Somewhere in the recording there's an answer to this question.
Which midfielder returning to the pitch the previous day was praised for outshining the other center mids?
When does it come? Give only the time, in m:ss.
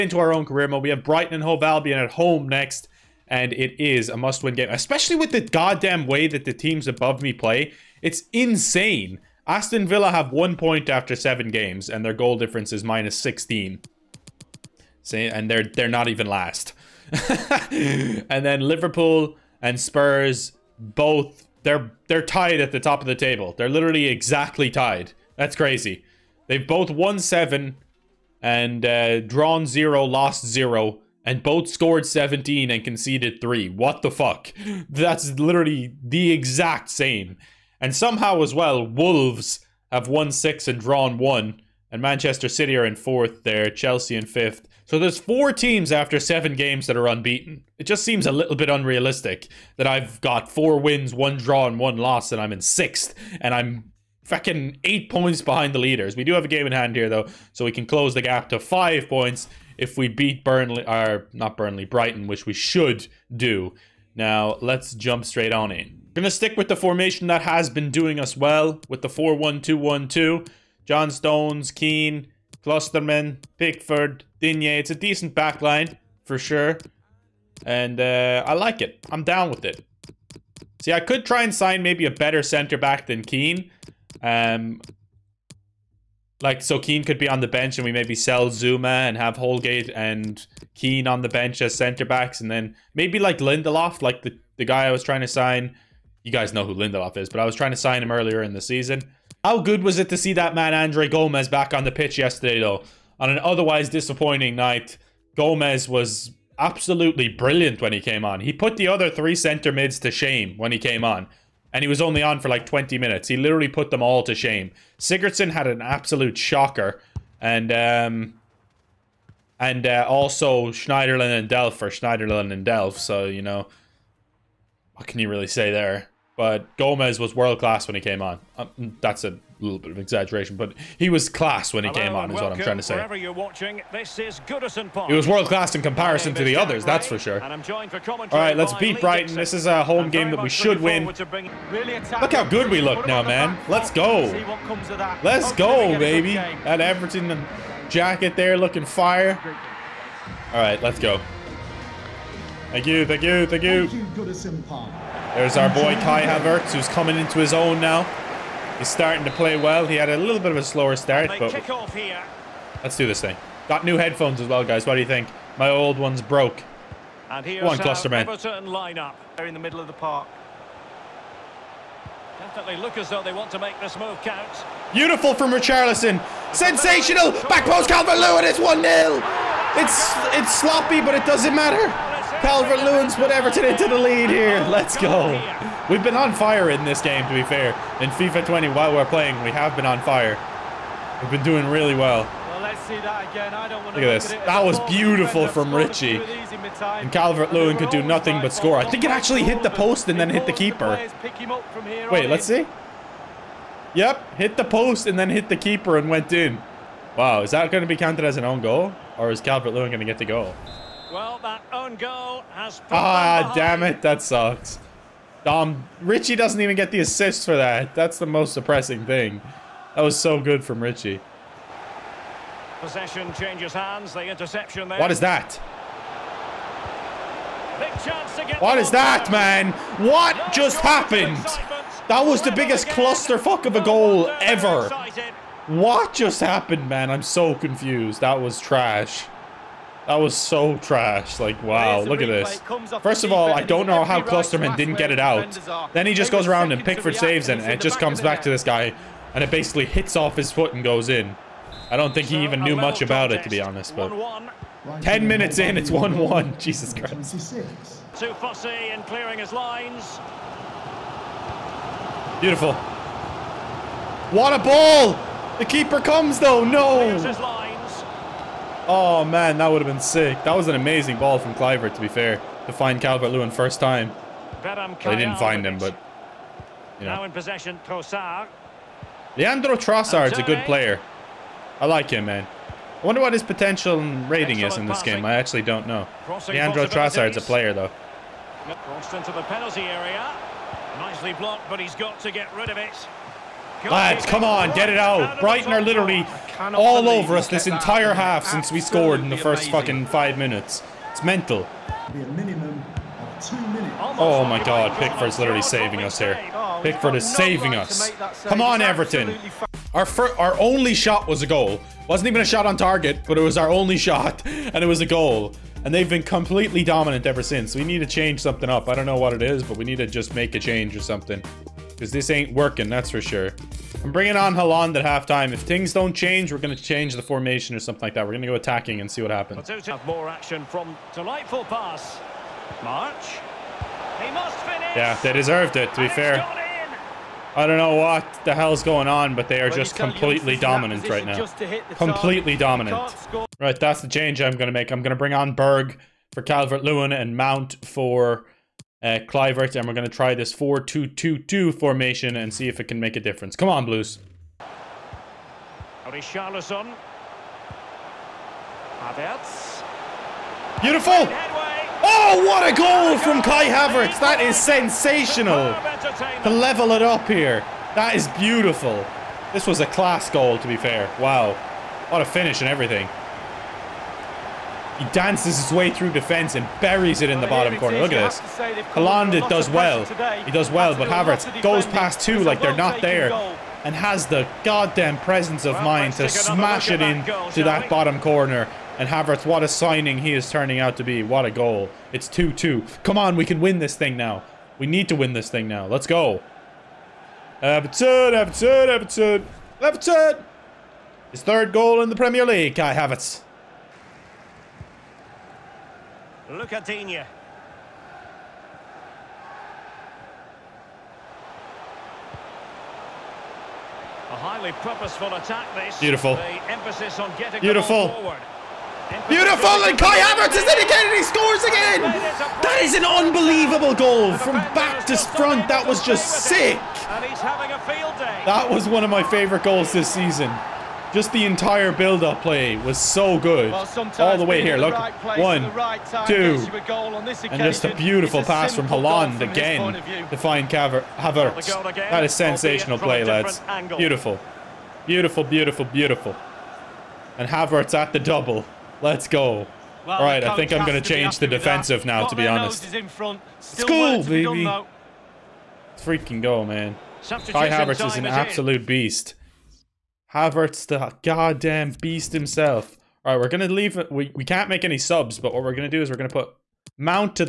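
1:40.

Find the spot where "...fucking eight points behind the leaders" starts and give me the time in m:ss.
0:54.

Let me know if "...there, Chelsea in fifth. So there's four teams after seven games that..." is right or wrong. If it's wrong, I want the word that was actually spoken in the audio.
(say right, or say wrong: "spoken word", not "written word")
right.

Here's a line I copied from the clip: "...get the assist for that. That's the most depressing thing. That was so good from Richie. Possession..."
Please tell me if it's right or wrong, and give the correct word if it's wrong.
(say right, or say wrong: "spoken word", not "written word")
right.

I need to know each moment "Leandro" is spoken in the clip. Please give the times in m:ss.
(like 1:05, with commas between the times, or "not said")
4:39, 4:46.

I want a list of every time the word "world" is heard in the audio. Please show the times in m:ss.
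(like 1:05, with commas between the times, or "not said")
2:07, 2:15.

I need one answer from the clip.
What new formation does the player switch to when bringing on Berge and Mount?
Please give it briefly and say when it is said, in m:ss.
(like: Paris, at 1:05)
4-2-2-2, at 5:50.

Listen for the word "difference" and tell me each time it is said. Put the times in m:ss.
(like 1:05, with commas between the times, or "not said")
0:12, 5:53.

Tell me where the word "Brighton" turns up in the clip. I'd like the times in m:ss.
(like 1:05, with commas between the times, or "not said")
0:01, 1:01, 2:18, 4:55.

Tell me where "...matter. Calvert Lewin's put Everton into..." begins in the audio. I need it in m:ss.
3:01.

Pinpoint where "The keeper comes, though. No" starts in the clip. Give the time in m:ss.
4:25.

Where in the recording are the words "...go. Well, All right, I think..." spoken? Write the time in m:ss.
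7:29.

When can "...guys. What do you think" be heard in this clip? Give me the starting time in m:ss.
2:44.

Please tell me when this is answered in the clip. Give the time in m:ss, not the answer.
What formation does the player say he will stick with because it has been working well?
1:09.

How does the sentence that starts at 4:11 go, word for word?
I don't think he even knew much about it, to be honest.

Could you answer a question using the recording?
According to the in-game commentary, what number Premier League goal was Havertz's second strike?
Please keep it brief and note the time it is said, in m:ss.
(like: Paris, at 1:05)
third, at 6:41.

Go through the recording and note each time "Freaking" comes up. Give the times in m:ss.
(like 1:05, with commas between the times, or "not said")
7:35.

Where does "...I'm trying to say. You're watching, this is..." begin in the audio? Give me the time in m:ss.
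2:12.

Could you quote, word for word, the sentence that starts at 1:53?
He literally put them all to shame.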